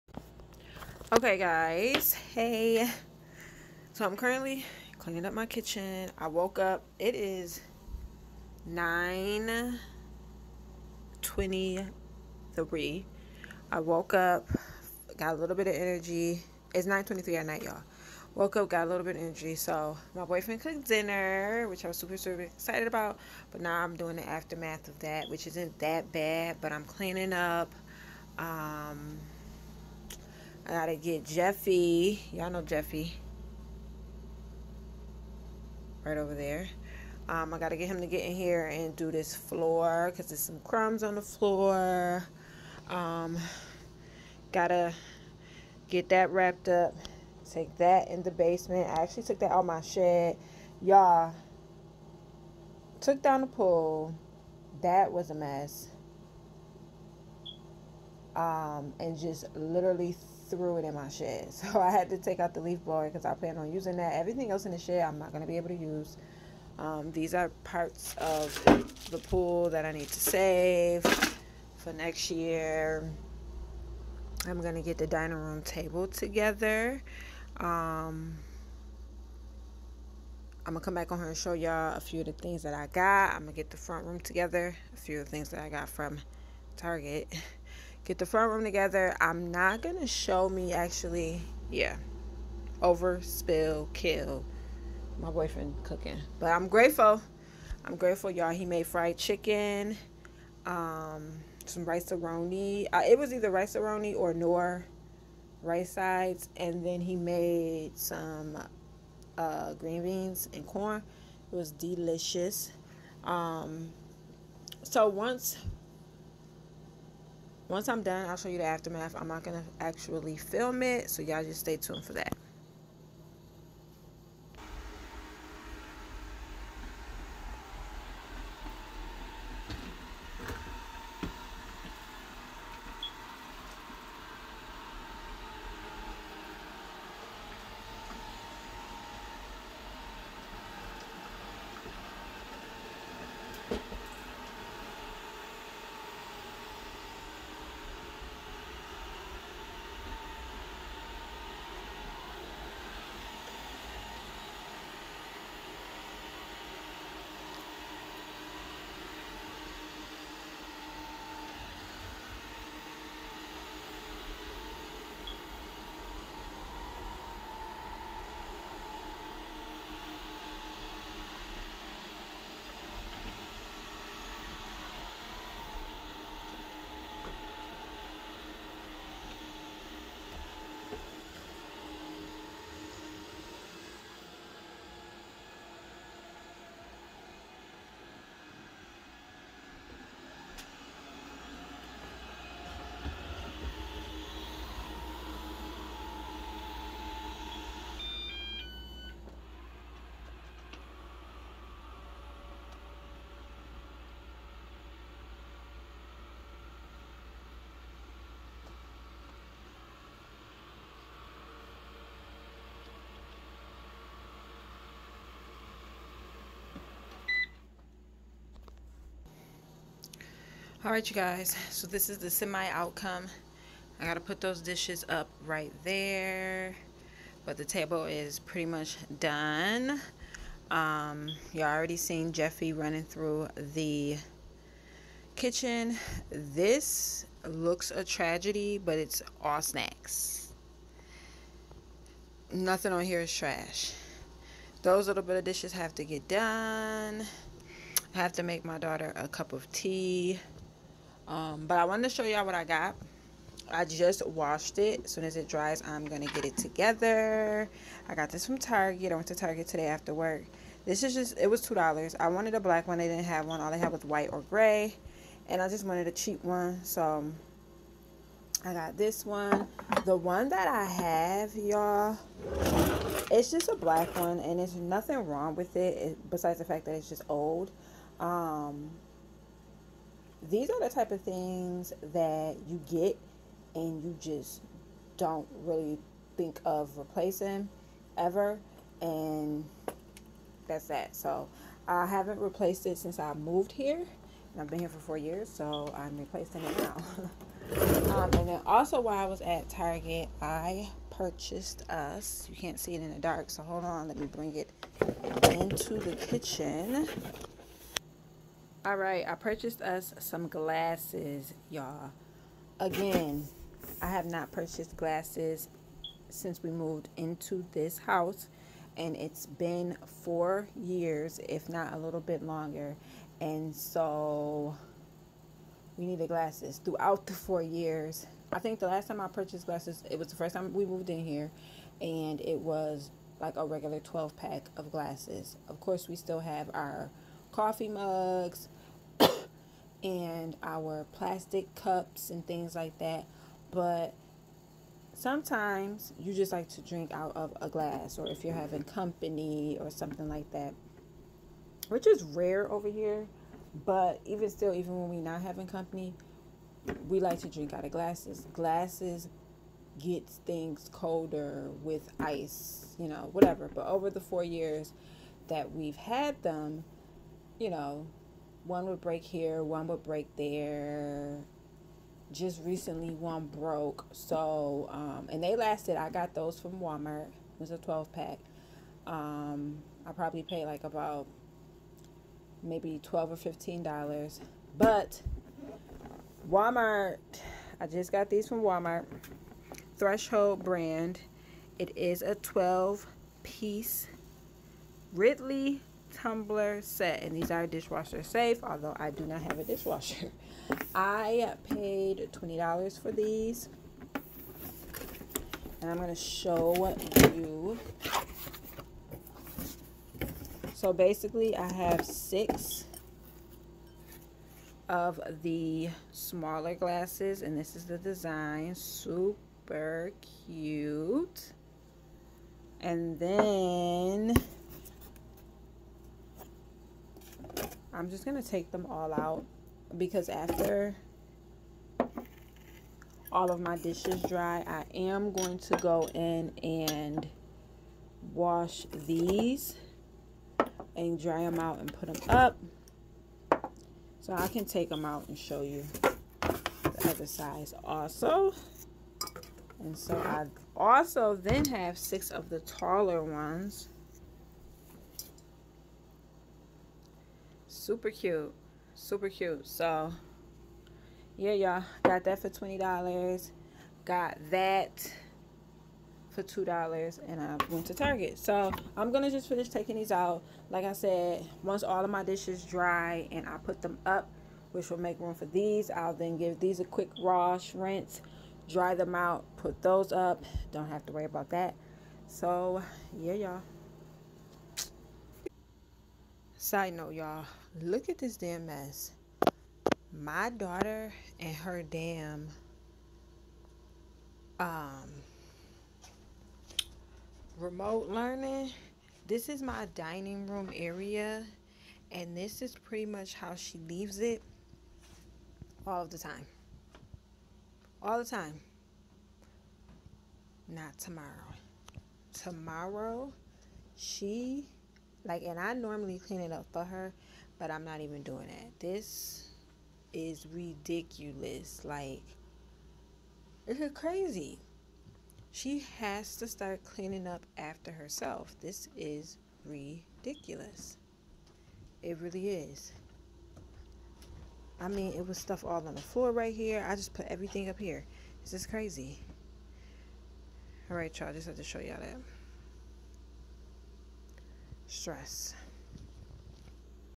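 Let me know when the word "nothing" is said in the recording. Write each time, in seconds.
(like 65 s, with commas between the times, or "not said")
242 s, 274 s.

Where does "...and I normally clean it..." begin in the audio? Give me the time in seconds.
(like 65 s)
515 s.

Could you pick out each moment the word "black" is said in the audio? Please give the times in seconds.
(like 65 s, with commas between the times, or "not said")
262 s, 273 s.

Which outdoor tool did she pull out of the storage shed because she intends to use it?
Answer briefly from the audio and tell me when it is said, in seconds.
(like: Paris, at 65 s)
leaf blower, at 62 s.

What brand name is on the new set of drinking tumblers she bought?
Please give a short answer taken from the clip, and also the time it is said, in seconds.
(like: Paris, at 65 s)
Threshold, at 389 s.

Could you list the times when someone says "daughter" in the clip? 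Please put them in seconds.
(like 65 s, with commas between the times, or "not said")
248 s, 490 s.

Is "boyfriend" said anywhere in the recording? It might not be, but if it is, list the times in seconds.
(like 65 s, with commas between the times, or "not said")
20 s, 95 s.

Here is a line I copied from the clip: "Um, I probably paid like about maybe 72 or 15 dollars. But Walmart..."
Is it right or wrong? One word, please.
wrong.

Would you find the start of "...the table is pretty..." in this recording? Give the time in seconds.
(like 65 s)
227 s.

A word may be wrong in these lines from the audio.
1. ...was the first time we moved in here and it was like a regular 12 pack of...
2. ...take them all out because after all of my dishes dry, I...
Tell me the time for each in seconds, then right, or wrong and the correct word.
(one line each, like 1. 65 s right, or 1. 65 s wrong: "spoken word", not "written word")
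1. 330 s right
2. 428 s right.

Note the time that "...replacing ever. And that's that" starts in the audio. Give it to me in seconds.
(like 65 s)
286 s.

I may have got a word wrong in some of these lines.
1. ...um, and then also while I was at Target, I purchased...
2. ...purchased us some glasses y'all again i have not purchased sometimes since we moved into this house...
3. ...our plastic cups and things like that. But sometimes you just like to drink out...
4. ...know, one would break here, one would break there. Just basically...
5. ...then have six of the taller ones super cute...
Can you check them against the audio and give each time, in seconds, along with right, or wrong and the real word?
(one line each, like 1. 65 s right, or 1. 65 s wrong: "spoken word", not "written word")
1. 298 s right
2. 309 s wrong: "glasses", not "sometimes"
3. 340 s right
4. 367 s wrong: "recently", not "basically"
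5. 451 s right.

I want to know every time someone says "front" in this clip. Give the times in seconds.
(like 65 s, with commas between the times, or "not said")
83 s, 88 s.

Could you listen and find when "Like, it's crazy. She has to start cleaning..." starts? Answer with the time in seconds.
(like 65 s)
521 s.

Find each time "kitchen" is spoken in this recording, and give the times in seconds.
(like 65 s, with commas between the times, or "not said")
5 s, 235 s, 306 s.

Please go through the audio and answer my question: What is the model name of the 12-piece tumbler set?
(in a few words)
Ridley.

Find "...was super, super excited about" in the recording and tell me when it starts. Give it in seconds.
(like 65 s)
21 s.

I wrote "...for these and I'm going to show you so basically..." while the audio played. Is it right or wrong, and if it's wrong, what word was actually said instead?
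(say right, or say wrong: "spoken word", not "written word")
right.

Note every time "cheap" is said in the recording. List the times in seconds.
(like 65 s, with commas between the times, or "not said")
266 s.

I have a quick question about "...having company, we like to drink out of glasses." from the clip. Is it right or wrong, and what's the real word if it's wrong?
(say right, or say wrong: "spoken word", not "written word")
right.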